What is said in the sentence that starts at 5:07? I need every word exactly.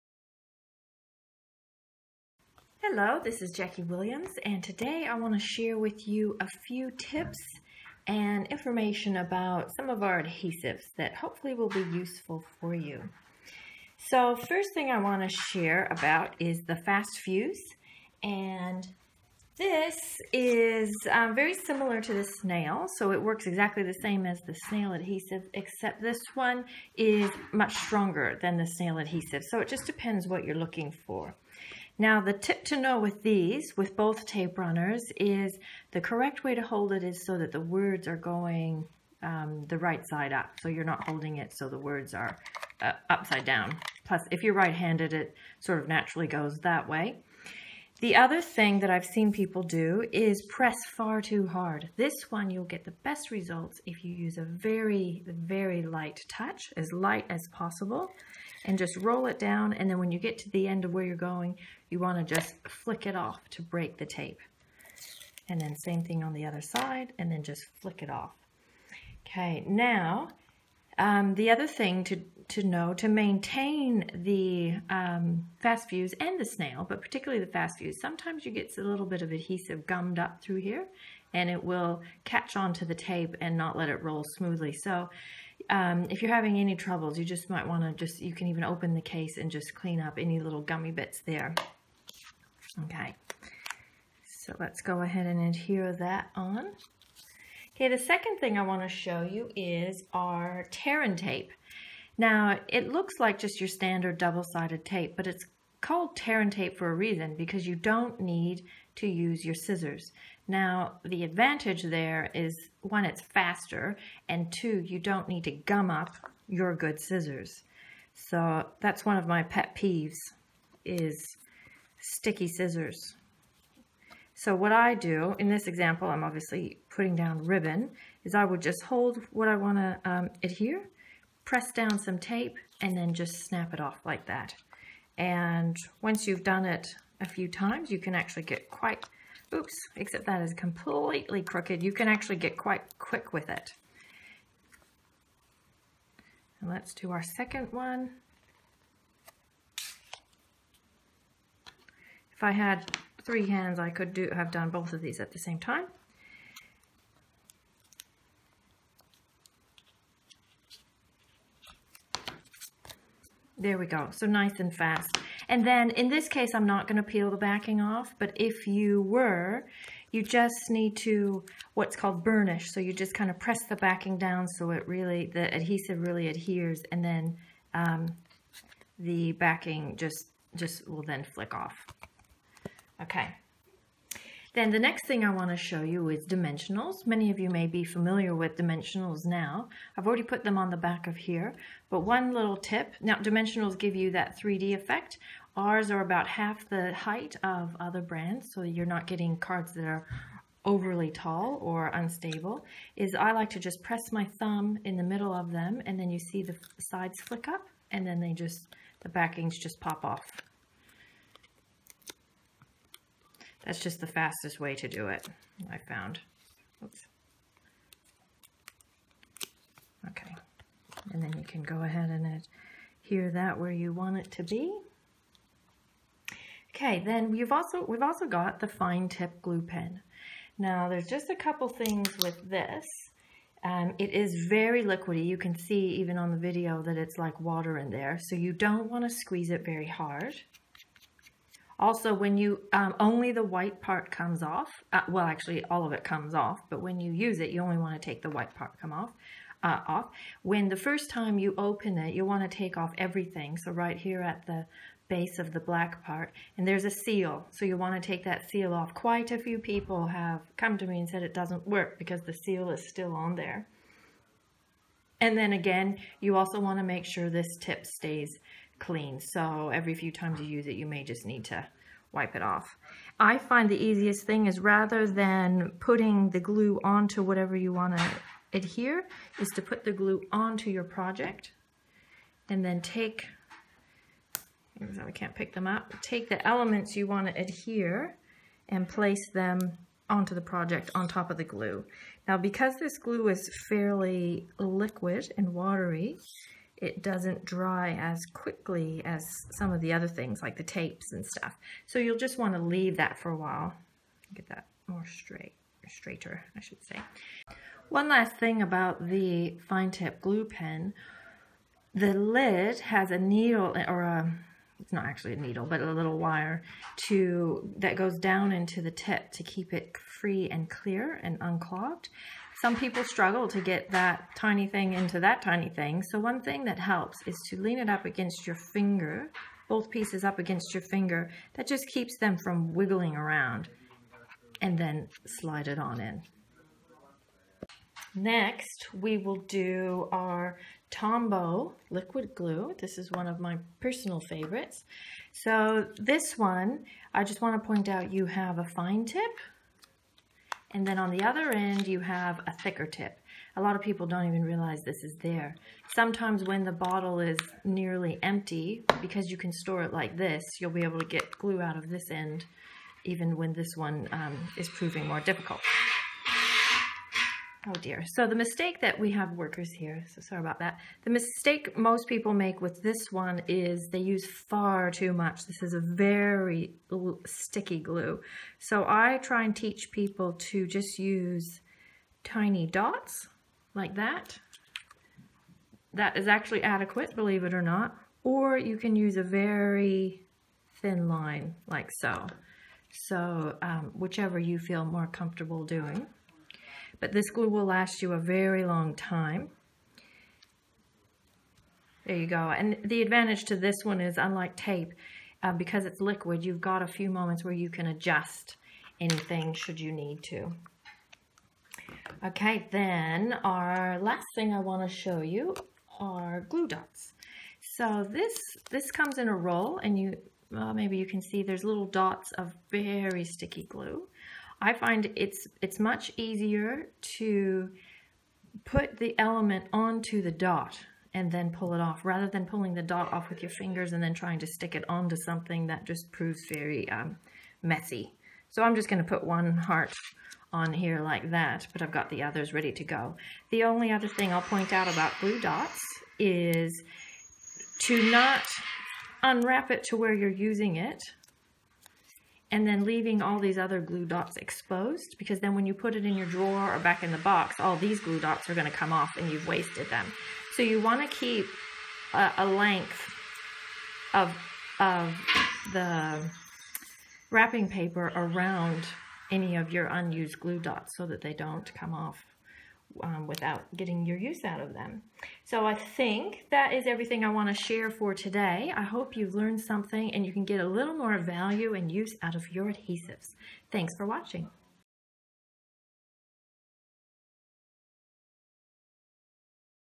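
One last thing about the fine tip glue pen.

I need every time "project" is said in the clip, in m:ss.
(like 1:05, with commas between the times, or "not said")
4:40, 4:50.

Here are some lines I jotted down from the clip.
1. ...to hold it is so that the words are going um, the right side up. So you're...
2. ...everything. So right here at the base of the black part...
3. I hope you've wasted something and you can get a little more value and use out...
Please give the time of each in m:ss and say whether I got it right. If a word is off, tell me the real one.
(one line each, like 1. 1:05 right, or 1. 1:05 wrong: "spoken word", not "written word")
1. 0:36 right
2. 4:12 right
3. 7:58 wrong: "learned", not "wasted".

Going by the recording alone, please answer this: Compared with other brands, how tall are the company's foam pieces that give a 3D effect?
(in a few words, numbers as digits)
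about half the height.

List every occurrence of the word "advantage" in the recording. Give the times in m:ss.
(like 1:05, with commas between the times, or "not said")
1:51, 6:43.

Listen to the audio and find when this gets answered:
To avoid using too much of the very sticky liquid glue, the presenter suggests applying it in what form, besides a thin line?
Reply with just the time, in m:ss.
6:22.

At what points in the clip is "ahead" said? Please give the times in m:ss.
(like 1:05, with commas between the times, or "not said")
1:35, 3:41.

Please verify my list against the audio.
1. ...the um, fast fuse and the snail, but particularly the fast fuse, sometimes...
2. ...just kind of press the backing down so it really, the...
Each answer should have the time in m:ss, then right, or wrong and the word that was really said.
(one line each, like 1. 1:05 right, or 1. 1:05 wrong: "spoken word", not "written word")
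1. 1:14 right
2. 2:52 right.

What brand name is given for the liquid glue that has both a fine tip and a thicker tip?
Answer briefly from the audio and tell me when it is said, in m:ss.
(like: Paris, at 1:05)
Tombow, at 5:40.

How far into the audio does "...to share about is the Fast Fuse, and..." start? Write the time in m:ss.
0:15.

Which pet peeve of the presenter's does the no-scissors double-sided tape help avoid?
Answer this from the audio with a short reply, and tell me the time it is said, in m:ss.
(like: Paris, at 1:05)
sticky scissors, at 2:01.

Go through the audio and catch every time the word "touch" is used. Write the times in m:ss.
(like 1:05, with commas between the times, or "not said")
0:56.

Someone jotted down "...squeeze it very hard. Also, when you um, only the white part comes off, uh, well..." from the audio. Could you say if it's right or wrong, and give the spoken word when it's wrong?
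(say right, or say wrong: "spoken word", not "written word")
right.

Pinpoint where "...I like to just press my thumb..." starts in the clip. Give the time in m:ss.
3:23.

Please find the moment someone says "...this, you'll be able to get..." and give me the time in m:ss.
6:00.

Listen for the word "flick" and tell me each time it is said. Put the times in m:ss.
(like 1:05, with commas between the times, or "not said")
1:02, 1:07, 3:01, 3:27.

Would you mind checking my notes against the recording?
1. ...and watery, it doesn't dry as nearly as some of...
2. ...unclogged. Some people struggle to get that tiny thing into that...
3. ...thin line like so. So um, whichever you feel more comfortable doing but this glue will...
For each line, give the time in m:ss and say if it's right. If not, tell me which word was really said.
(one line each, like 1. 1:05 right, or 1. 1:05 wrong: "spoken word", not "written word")
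1. 4:55 wrong: "quickly", not "nearly"
2. 5:21 right
3. 6:30 right.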